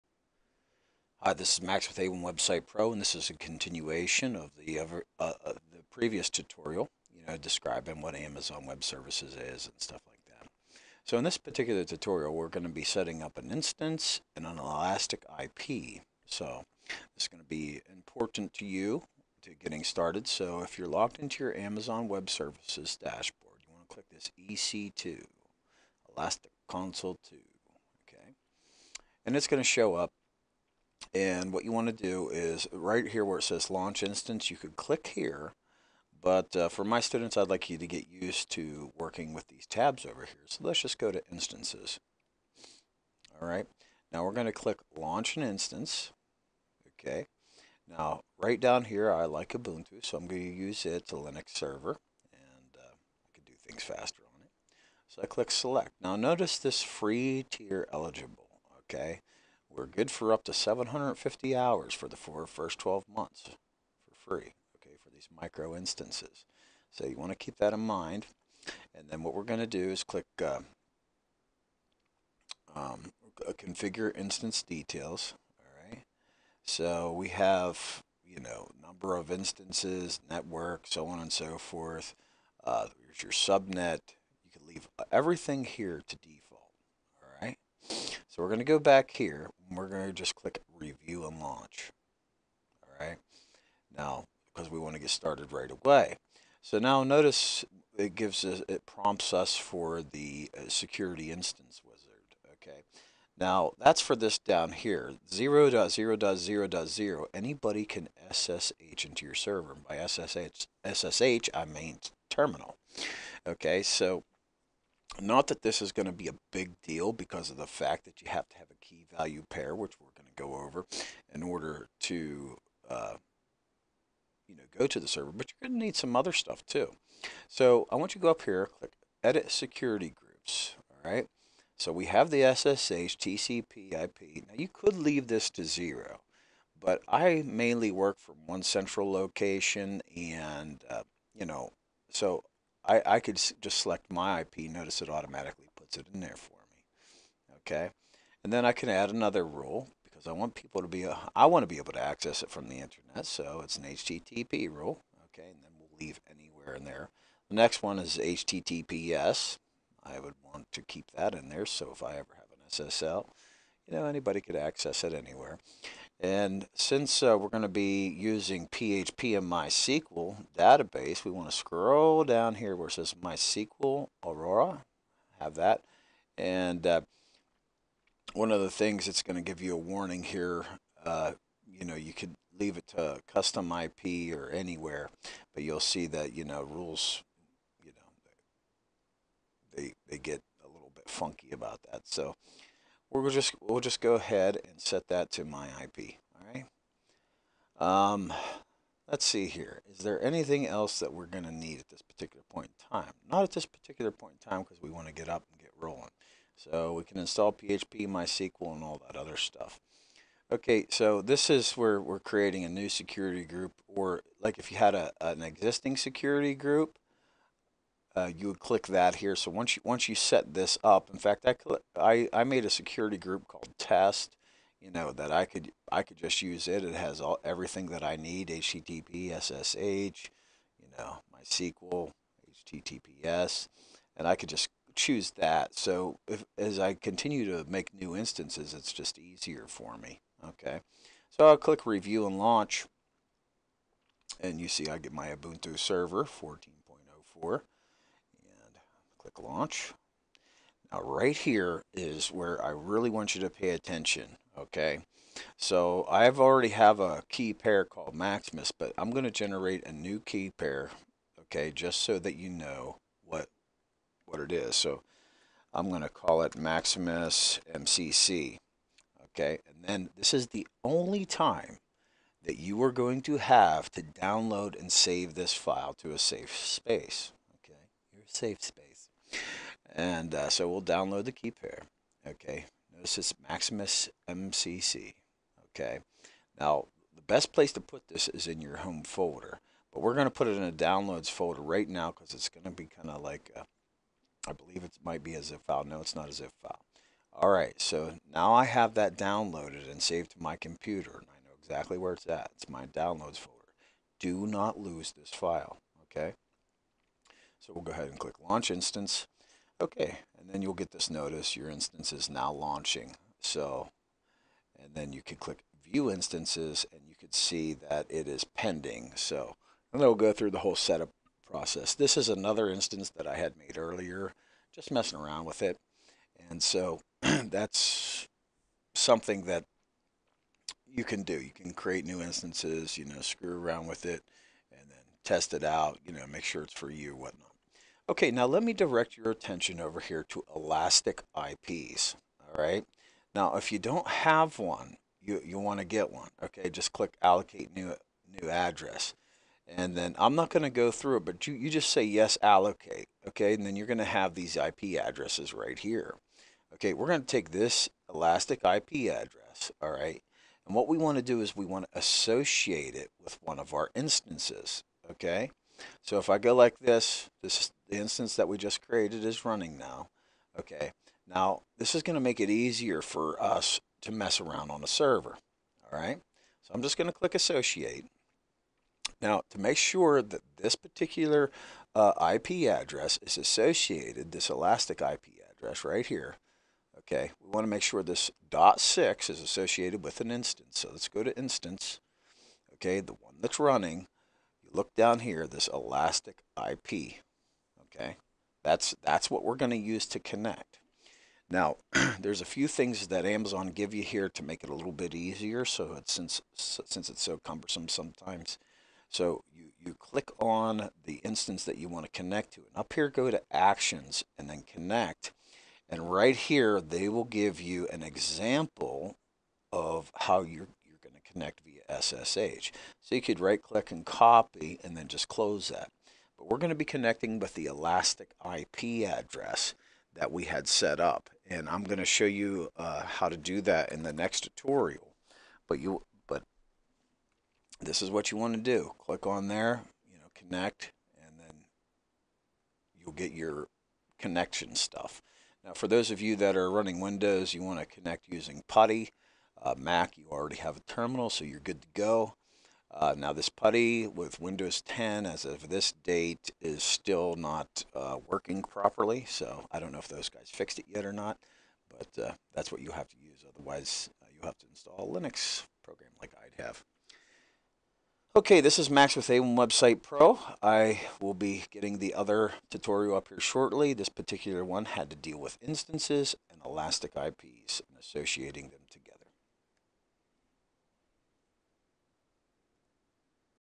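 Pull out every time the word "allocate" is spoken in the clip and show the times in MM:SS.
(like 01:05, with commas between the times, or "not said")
05:47, 05:52.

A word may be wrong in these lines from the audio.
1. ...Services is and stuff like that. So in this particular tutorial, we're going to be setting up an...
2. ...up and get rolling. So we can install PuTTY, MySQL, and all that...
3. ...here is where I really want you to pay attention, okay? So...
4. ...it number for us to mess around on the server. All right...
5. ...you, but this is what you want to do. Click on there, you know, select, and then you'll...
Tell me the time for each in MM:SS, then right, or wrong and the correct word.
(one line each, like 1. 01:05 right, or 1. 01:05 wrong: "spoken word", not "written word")
1. 00:08 right
2. 03:25 wrong: "PHP", not "PuTTY"
3. 04:11 right
4. 06:12 wrong: "easier", not "number"
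5. 07:15 wrong: "connect", not "select".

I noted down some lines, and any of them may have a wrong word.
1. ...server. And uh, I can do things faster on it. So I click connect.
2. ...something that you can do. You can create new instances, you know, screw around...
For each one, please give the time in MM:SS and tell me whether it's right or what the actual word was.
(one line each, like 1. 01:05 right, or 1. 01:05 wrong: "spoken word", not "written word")
1. 00:51 wrong: "select", not "connect"
2. 05:28 right.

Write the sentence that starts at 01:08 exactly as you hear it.
And then what we're going to do is click uh, um, configure instance details.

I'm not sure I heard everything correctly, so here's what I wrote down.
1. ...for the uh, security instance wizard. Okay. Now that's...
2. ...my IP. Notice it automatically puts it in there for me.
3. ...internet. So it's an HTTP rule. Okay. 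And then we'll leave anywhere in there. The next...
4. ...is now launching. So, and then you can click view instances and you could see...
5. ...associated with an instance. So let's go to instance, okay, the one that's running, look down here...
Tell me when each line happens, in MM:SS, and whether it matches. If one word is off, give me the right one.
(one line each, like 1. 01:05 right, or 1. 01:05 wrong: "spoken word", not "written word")
1. 01:39 right
2. 02:24 right
3. 02:32 right
4. 05:12 right
5. 06:29 right.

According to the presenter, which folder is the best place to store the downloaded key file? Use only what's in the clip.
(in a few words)
home folder.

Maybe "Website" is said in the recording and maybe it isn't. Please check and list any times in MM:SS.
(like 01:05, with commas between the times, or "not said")
00:02, 07:49.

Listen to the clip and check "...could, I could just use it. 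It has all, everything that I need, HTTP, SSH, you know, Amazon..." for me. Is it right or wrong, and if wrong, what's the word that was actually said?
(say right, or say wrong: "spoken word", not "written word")
wrong: "MySQL", not "Amazon".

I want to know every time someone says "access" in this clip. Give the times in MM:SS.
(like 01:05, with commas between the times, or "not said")
02:32, 02:44.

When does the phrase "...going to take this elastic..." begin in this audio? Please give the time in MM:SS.
05:57.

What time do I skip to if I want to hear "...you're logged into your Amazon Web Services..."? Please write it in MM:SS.
00:20.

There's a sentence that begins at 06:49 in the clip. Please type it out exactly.
So you, you click on the instance that you want to connect to.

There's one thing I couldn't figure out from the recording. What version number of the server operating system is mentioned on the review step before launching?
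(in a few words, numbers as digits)
14.04.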